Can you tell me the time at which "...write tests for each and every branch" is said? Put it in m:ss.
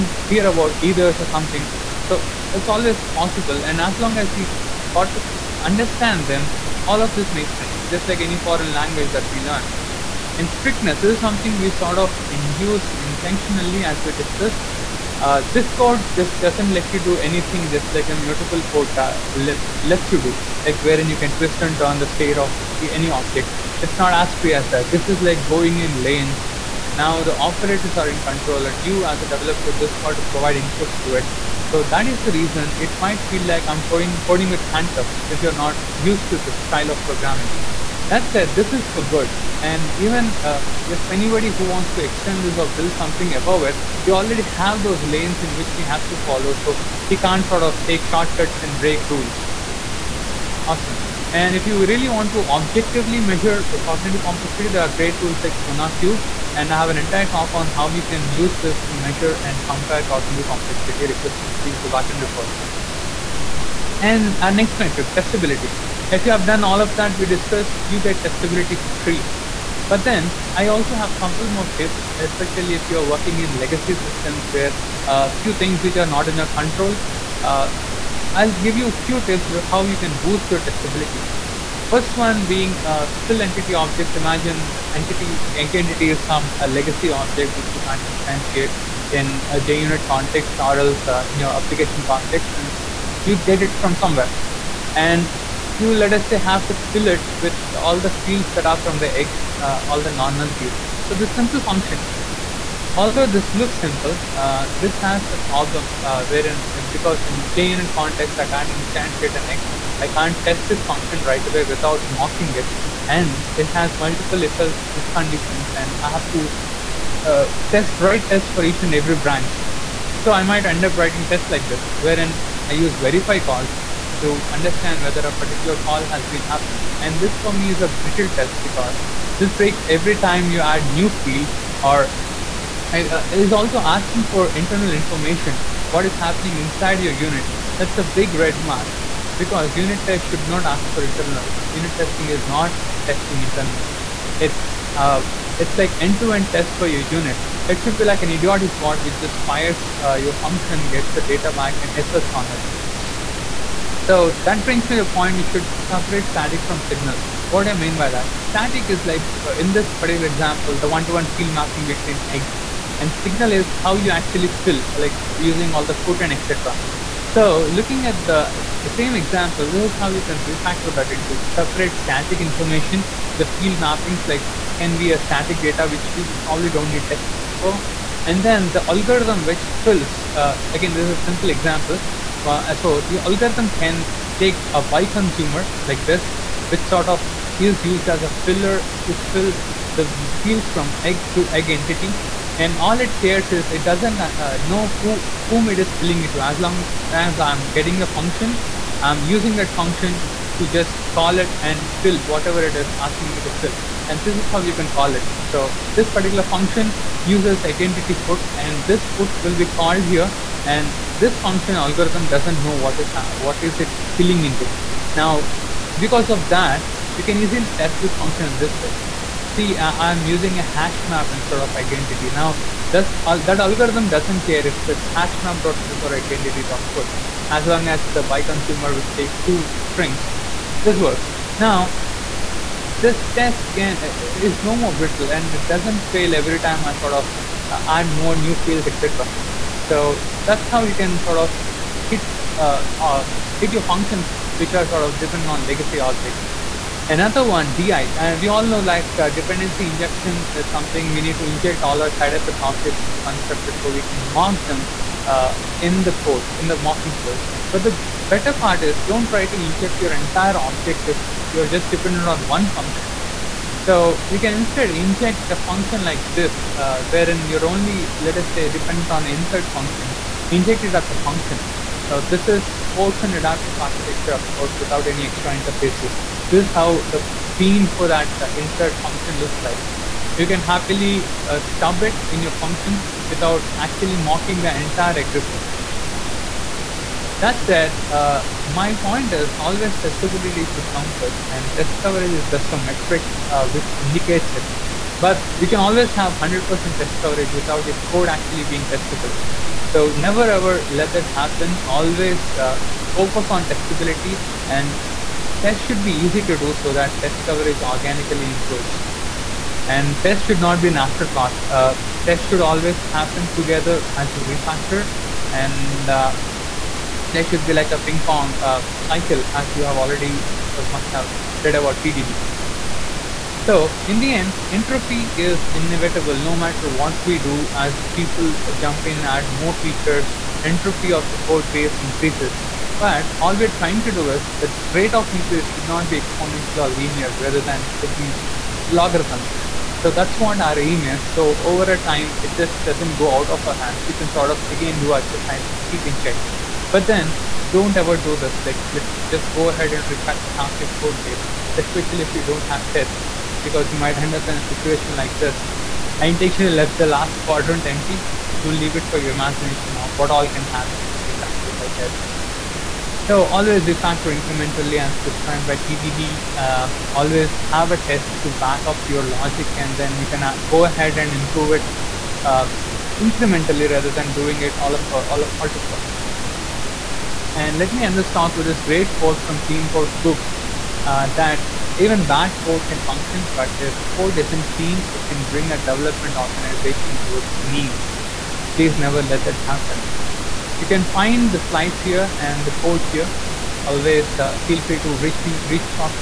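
1:57.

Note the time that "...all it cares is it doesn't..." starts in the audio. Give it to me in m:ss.
3:12.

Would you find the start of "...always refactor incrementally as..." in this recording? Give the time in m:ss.
6:03.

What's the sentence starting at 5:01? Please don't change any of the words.
Always uh, focus on testability and test should be easy to do so that test coverage organically improves.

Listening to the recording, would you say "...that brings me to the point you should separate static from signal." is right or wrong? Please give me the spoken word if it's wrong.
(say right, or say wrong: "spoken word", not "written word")
right.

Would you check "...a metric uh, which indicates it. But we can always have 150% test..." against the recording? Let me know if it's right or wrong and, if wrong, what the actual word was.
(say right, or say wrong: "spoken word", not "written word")
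wrong: "100", not "150".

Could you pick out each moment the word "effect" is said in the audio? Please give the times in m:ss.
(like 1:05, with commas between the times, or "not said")
4:12.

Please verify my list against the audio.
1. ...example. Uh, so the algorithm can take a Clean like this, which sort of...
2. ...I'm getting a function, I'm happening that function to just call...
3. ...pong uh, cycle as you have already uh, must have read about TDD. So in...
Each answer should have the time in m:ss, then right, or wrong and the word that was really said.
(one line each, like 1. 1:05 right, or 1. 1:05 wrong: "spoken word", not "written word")
1. 3:01 wrong: "BiConsumer", not "Clean"
2. 3:17 wrong: "using", not "happening"
3. 5:18 right.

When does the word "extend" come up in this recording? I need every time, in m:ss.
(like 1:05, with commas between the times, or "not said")
0:42.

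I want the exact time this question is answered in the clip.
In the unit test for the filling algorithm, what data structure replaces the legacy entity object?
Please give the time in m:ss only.
3:40.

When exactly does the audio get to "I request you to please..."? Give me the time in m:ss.
1:01.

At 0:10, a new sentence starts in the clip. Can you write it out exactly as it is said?
And strictness this is something we sort of induced intentionally, as we discussed.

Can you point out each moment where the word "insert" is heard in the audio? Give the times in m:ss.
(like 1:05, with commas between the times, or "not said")
4:29, 4:38.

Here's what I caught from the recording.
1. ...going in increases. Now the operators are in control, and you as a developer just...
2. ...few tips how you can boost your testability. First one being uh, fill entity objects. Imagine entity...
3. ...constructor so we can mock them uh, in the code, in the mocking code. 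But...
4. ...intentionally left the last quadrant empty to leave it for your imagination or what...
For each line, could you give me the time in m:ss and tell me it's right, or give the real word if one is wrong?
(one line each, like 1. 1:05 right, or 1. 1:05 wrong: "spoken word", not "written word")
1. 0:25 wrong: "lanes", not "increases"
2. 1:18 right
3. 4:13 right
4. 5:56 right.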